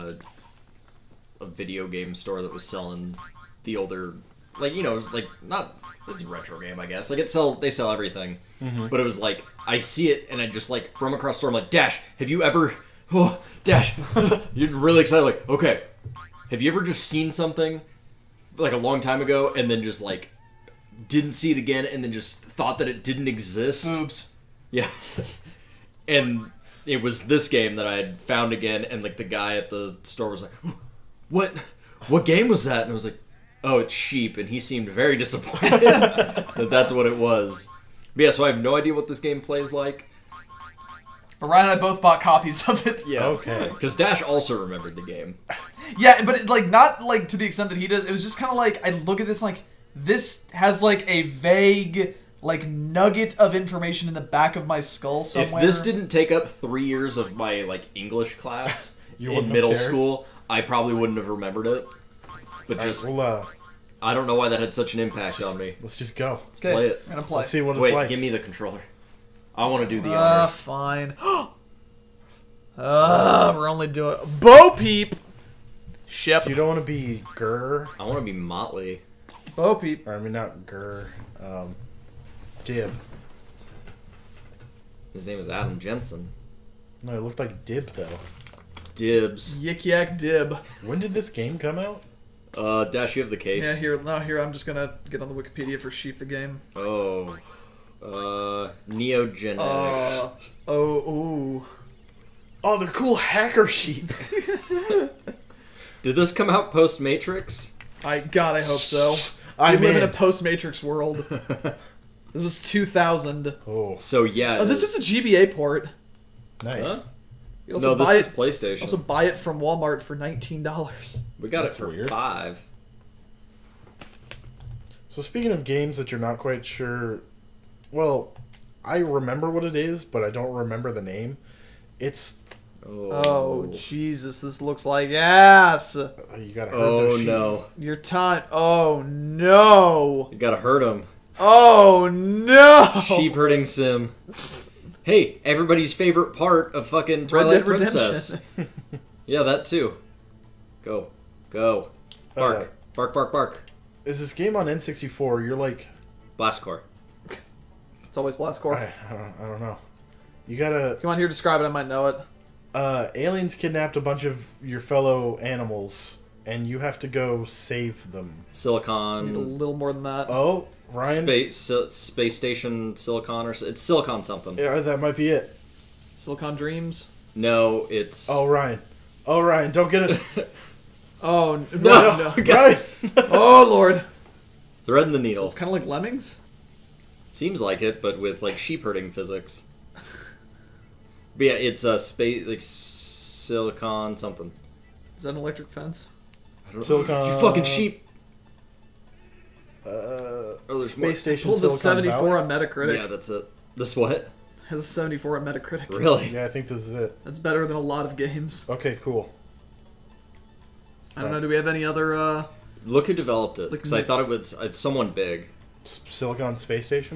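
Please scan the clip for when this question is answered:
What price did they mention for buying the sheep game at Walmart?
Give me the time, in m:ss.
2:00.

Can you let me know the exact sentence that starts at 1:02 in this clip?
But just we'll, uh, I don't know why that had such an impact just, on me.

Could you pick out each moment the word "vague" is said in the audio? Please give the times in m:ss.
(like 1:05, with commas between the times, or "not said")
0:51.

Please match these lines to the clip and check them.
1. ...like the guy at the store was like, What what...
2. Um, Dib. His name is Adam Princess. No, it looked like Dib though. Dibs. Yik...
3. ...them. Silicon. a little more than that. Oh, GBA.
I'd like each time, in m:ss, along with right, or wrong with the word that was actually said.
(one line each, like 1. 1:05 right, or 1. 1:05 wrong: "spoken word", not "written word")
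1. 0:29 right
2. 1:21 wrong: "Jensen", not "Princess"
3. 2:48 wrong: "Ryan", not "GBA".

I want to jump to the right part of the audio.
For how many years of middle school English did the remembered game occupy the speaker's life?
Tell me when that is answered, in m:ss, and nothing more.
0:56.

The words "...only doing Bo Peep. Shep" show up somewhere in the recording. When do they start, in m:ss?
1:13.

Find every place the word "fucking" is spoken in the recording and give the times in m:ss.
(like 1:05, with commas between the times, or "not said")
2:26, 3:17.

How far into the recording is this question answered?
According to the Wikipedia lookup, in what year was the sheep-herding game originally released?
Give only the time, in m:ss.
1:52.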